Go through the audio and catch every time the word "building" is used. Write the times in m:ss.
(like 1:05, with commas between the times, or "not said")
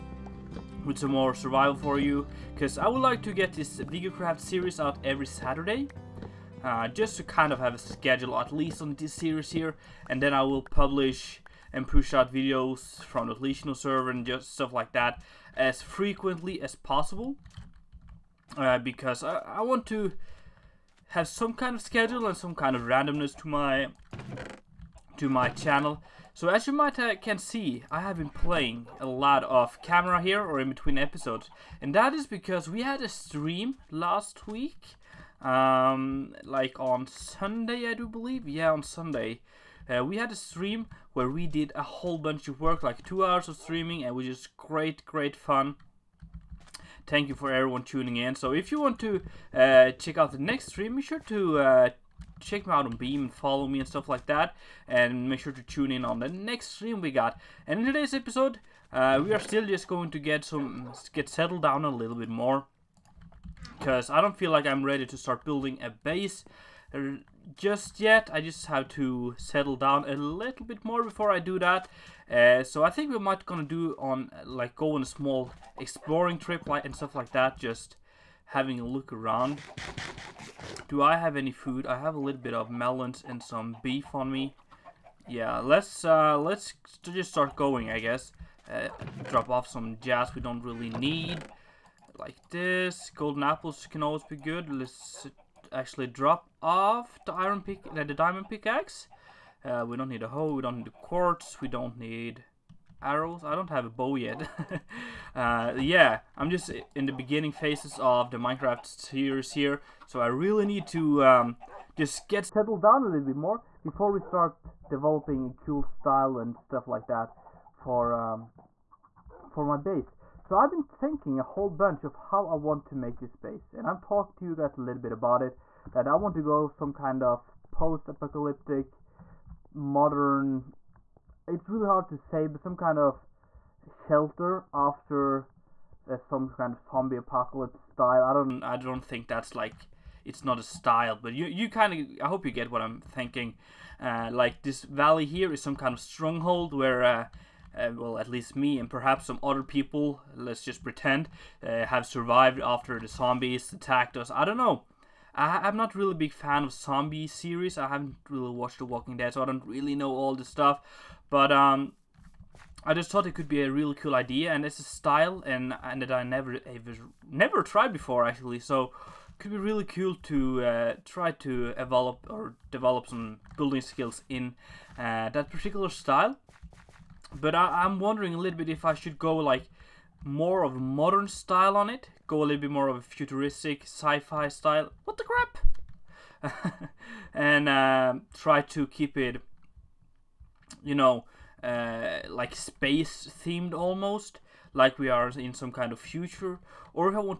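1:05, 2:53.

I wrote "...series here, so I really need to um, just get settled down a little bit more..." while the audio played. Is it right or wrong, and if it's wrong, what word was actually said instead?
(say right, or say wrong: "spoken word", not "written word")
right.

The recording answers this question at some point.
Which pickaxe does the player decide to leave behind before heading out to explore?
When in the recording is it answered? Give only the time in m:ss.
1:38.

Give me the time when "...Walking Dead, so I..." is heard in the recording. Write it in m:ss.
2:38.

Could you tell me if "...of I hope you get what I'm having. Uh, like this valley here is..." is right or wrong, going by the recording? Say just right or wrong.
wrong.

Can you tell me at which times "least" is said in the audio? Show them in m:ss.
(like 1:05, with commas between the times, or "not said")
0:08, 2:28.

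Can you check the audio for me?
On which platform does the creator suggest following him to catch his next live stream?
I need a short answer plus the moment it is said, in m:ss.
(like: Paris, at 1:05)
Beam, at 0:52.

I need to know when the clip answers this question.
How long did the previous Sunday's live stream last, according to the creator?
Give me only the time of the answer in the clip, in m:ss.
0:43.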